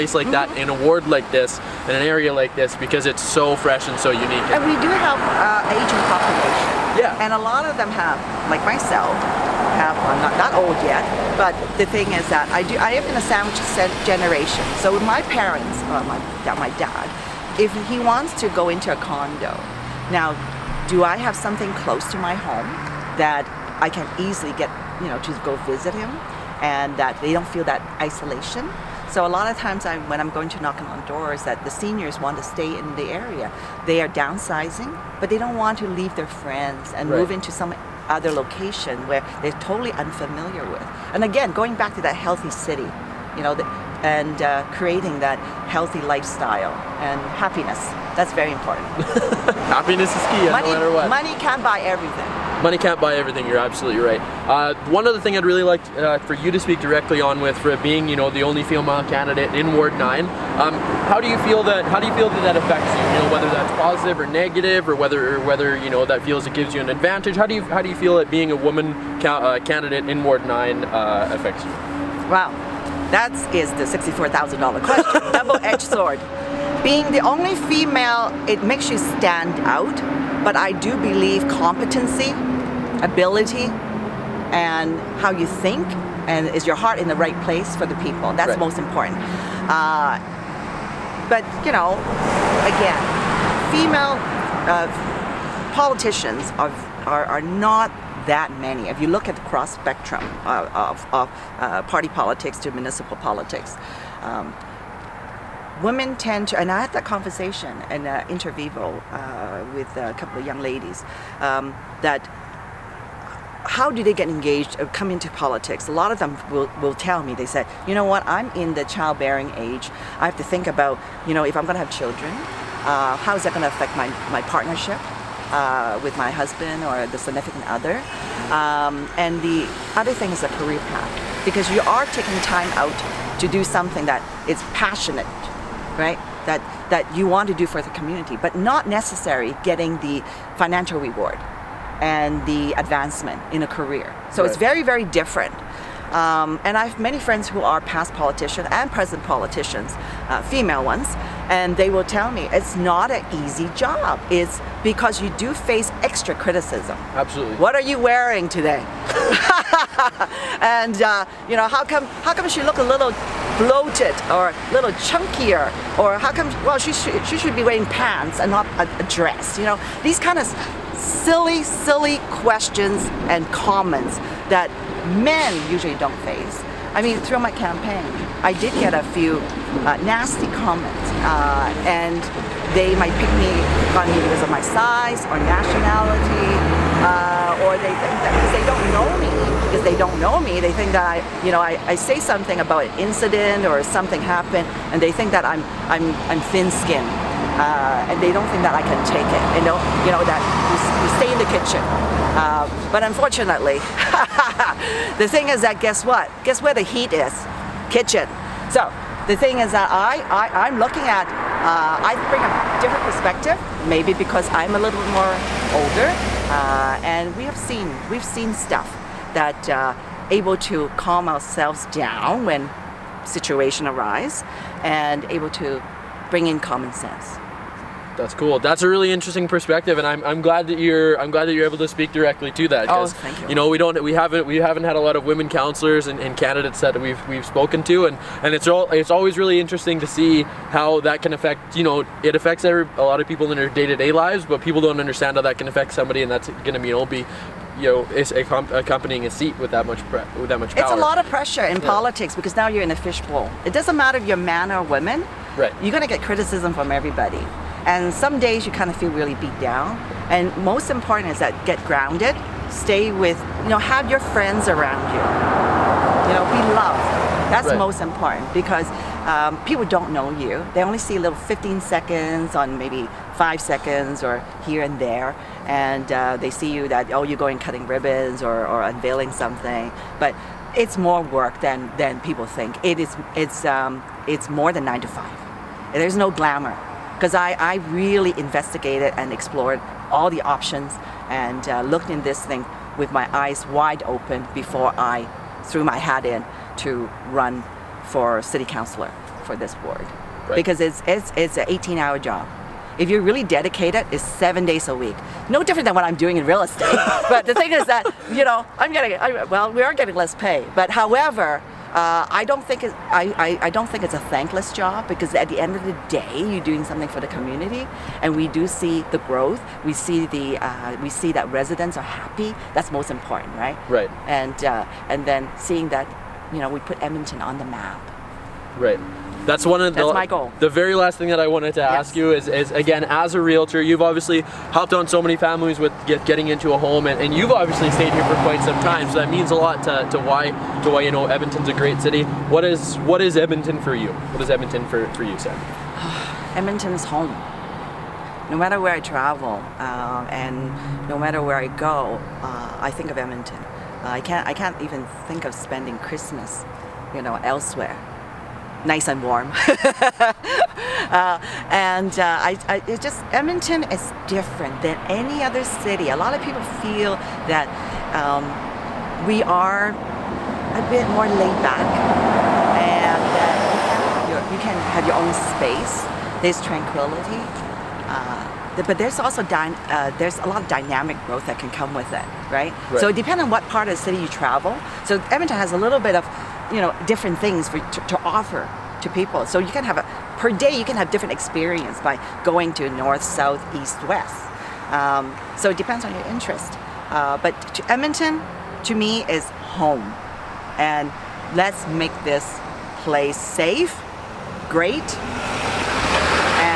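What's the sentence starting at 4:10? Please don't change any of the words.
It's a lot of pressure in yeah.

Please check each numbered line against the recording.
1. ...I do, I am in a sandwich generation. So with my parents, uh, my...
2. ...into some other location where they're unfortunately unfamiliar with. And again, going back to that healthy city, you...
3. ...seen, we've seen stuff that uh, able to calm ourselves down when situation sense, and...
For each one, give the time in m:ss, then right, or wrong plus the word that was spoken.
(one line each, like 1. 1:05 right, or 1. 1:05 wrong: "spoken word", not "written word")
1. 0:12 right
2. 0:37 wrong: "totally", not "unfortunately"
3. 3:37 wrong: "arise", not "sense".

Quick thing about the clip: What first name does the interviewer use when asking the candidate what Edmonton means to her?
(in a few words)
Sam.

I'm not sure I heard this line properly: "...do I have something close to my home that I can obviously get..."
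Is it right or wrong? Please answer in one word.
wrong.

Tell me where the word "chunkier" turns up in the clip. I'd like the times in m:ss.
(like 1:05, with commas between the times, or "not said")
2:45.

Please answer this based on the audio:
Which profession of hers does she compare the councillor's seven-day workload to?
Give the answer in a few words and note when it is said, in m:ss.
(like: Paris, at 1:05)
real estate, at 5:06.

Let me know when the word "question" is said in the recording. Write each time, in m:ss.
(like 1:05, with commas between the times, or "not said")
1:14, 2:52.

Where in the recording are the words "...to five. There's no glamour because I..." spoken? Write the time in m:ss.
4:45.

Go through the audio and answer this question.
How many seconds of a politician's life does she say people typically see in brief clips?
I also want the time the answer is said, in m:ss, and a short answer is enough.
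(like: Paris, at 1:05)
15, at 4:31.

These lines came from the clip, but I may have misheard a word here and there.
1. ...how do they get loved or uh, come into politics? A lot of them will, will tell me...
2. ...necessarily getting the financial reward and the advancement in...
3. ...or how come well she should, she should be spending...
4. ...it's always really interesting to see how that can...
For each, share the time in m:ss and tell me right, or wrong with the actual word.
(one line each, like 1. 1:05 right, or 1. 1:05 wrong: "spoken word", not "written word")
1. 1:53 wrong: "engaged", not "loved"
2. 2:18 right
3. 2:45 wrong: "wearing", not "spending"
4. 3:58 right.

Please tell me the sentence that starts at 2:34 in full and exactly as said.
It's because you do face extra criticism.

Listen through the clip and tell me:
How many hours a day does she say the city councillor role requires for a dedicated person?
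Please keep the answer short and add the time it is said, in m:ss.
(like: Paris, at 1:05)
18, at 5:01.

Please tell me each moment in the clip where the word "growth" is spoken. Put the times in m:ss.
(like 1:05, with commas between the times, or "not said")
5:19, 6:21.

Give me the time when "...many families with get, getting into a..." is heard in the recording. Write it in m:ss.
5:35.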